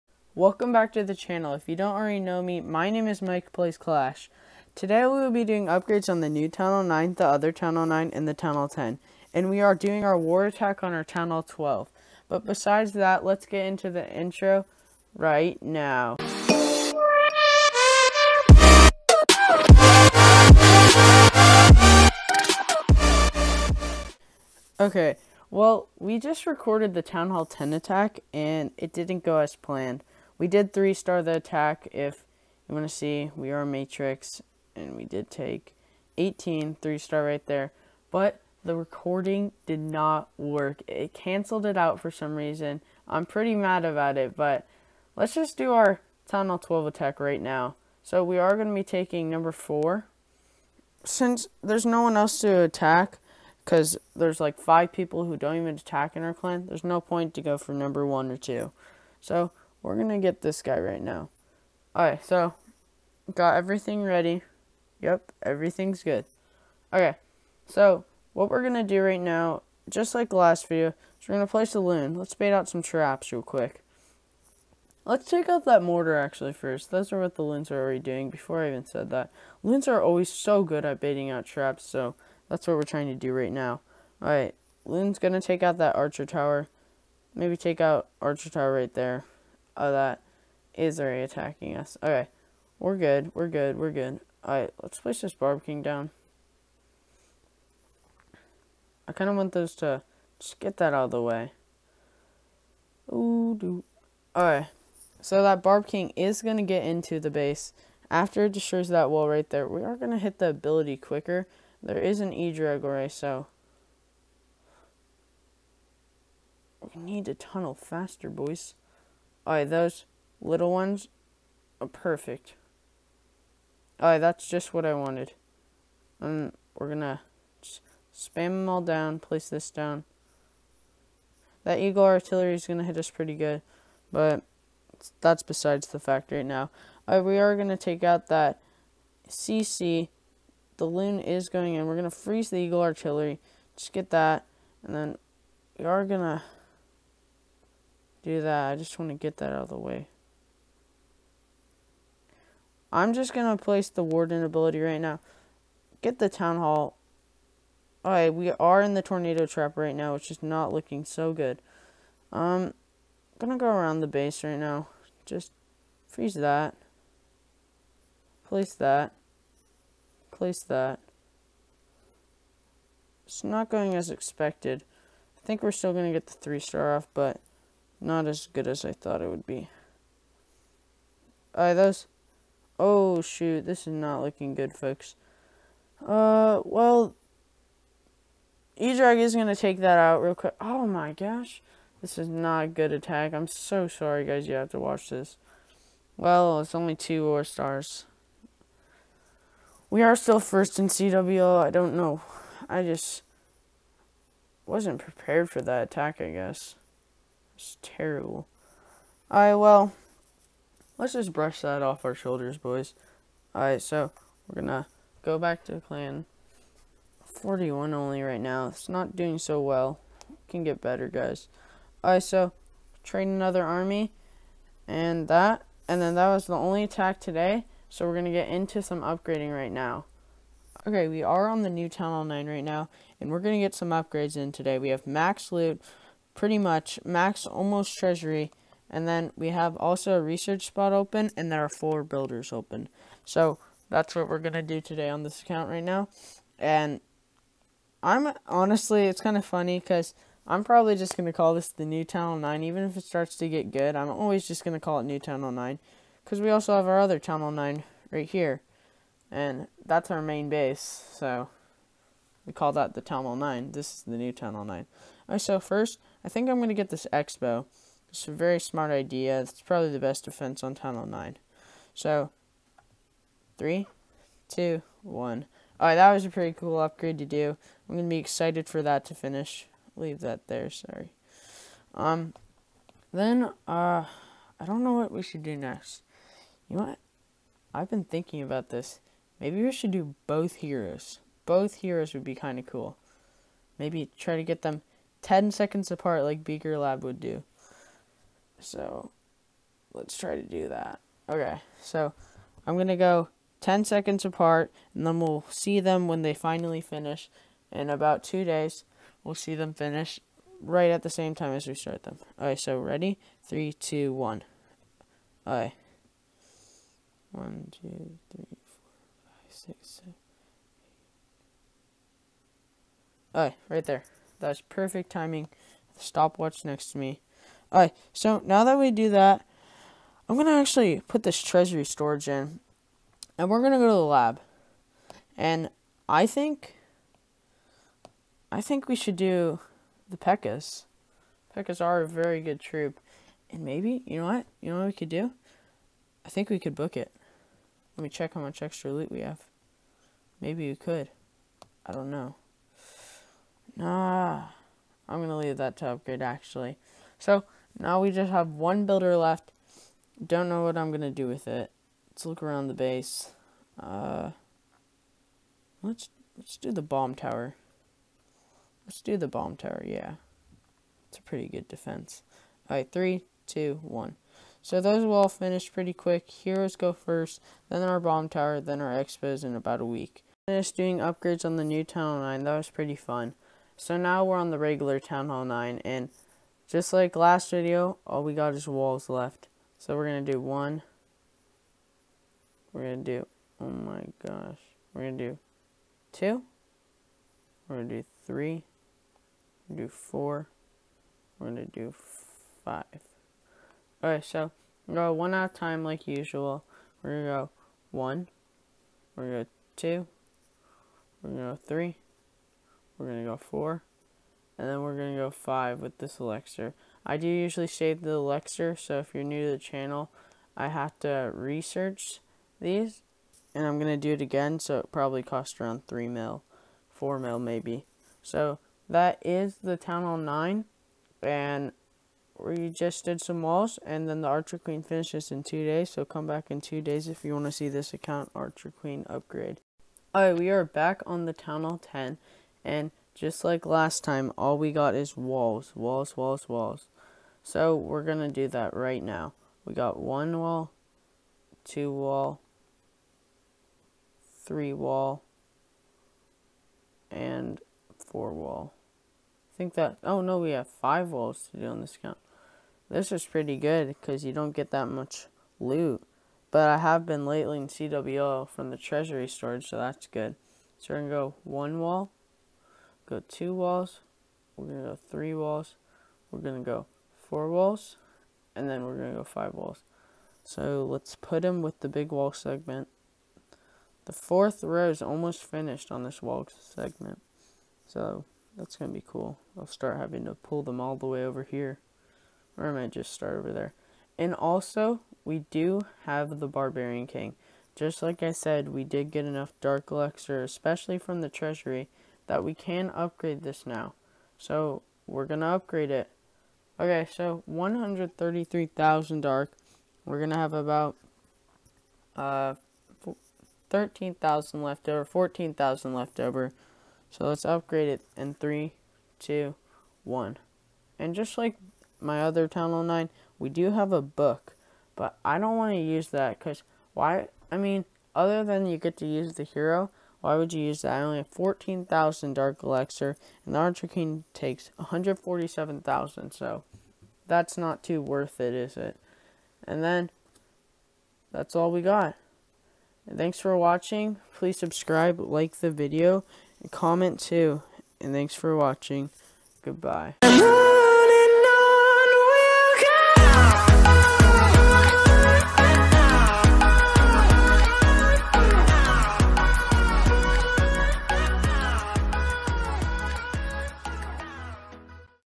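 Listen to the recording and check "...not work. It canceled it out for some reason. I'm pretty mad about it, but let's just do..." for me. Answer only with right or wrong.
right.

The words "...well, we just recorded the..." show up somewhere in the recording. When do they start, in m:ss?
0:25.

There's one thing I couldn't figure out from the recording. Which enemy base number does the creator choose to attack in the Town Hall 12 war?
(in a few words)
4.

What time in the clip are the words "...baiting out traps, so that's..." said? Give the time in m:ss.
1:21.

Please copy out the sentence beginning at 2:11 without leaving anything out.
That Eagle artillery is gonna hit us pretty good, but that's besides the fact right now.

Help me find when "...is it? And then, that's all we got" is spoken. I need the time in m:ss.
8:58.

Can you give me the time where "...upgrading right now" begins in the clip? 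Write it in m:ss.
3:49.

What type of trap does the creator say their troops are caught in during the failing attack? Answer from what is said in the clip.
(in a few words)
Tornado trap.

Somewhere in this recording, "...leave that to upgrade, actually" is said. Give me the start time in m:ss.
5:55.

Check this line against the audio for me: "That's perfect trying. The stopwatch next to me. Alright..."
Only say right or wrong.
wrong.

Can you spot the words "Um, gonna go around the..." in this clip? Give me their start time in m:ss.
2:42.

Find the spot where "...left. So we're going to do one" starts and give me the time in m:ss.
6:29.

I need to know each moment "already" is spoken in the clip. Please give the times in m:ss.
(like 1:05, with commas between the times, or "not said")
0:01, 1:17, 1:30.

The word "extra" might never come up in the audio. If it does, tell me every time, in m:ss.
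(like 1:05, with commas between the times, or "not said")
5:48.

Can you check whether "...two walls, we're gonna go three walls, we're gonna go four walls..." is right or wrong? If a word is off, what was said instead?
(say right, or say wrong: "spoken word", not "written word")
right.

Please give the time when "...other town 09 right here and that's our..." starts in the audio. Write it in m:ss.
4:16.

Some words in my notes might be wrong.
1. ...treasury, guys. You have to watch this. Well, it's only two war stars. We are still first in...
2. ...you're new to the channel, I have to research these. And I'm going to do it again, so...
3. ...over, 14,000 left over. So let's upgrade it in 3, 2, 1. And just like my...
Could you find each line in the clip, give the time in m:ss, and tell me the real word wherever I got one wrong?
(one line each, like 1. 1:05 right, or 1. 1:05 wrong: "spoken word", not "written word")
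1. 3:13 wrong: "sorry", not "treasury"
2. 6:59 right
3. 8:34 right.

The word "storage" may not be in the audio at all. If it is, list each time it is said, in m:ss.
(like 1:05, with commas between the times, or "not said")
5:31, 7:49.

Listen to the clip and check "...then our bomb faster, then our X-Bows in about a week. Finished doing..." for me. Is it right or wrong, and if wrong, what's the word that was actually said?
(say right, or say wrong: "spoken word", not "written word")
wrong: "tower", not "faster".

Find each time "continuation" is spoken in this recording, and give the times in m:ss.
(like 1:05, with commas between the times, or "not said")
not said.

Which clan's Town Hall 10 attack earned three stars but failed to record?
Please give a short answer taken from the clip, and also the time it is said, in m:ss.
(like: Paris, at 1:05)
Matrix, at 0:33.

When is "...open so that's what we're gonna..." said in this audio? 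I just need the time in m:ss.
4:02.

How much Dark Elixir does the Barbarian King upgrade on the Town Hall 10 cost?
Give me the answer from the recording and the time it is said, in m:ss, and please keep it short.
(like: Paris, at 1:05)
133,000, at 8:27.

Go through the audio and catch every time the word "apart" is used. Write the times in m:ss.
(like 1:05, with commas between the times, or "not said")
4:55, 5:04.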